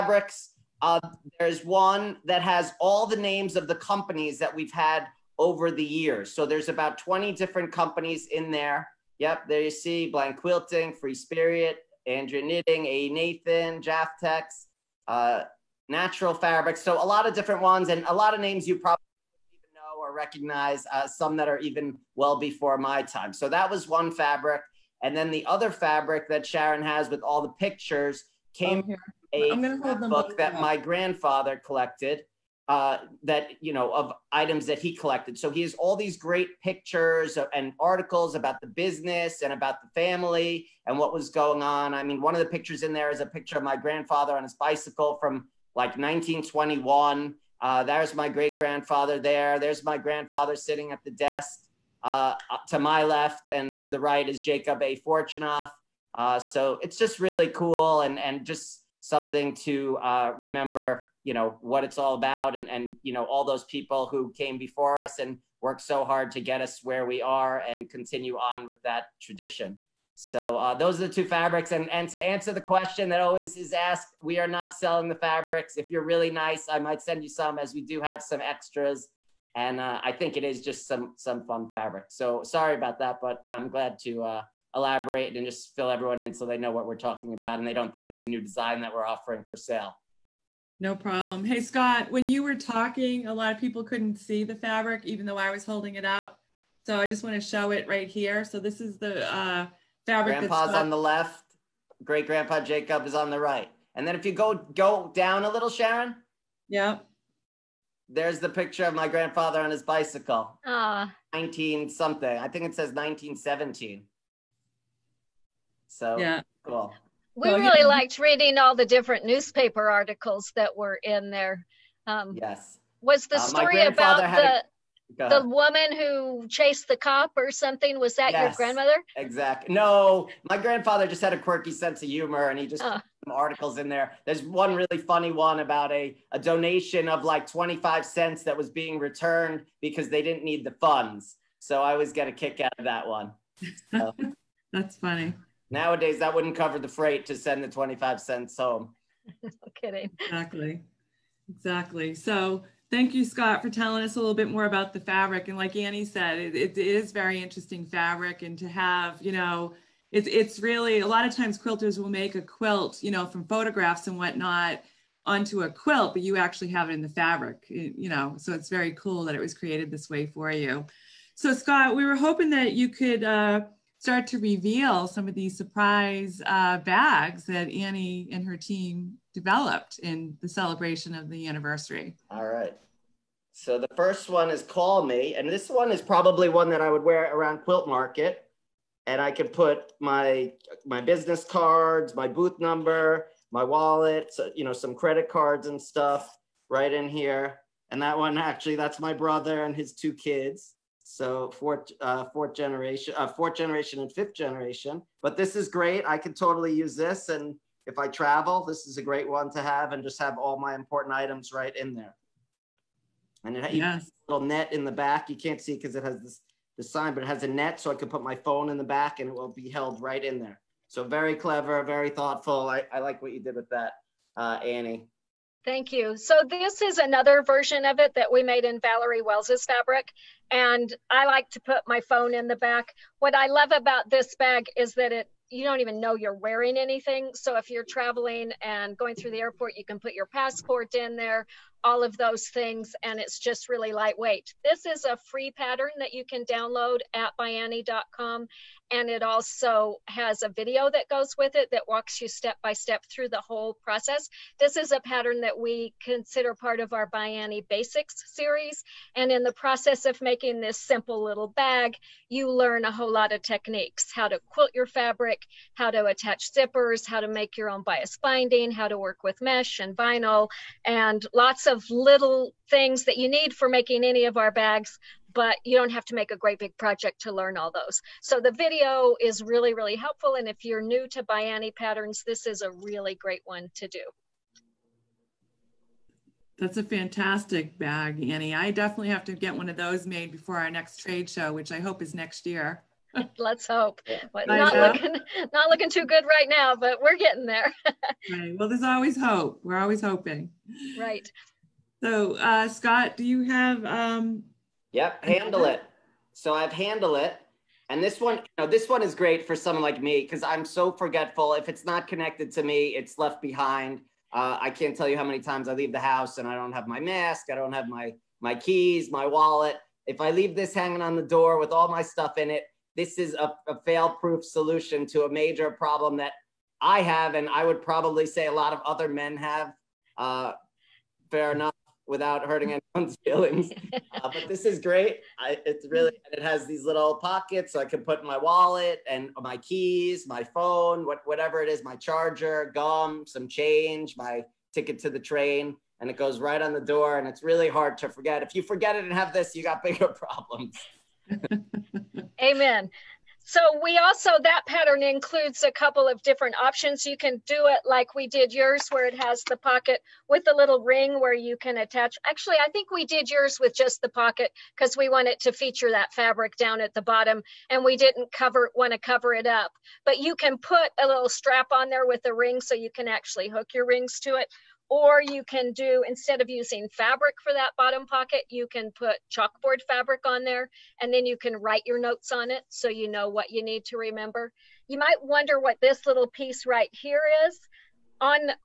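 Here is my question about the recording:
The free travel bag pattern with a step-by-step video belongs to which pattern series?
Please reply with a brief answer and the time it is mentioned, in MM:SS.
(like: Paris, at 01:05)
ByAnnie Basics, at 04:17.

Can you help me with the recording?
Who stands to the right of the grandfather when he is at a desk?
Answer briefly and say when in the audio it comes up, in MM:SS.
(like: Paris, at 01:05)
Jacob A. Fortunoff, at 00:54.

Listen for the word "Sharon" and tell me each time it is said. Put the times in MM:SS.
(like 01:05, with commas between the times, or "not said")
00:26, 01:45.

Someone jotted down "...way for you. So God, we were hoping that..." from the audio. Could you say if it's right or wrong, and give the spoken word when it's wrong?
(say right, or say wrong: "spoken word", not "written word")
wrong: "Scott", not "God".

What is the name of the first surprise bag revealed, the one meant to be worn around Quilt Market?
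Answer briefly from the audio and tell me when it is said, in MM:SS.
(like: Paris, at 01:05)
Call Me, at 03:04.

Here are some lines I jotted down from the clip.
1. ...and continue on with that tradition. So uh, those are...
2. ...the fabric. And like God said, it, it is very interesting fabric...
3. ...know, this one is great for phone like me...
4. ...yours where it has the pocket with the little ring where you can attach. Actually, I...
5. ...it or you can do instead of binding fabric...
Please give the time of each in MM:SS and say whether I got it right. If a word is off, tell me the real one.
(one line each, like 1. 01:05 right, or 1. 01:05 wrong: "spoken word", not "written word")
1. 01:07 right
2. 02:34 wrong: "Annie", not "God"
3. 05:08 wrong: "someone", not "phone"
4. 05:58 right
5. 06:14 wrong: "using", not "binding".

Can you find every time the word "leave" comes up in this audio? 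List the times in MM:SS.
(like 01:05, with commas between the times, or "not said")
05:15, 05:20.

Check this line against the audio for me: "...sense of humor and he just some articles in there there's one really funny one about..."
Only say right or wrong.
right.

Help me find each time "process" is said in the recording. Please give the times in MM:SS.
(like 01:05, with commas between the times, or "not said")
04:13, 04:19.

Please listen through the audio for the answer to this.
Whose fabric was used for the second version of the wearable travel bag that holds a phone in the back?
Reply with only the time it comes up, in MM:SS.
03:48.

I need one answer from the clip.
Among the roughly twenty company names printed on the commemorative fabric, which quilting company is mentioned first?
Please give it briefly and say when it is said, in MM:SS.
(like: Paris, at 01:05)
Blank Quilting, at 00:10.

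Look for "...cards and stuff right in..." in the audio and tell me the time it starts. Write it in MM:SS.
03:15.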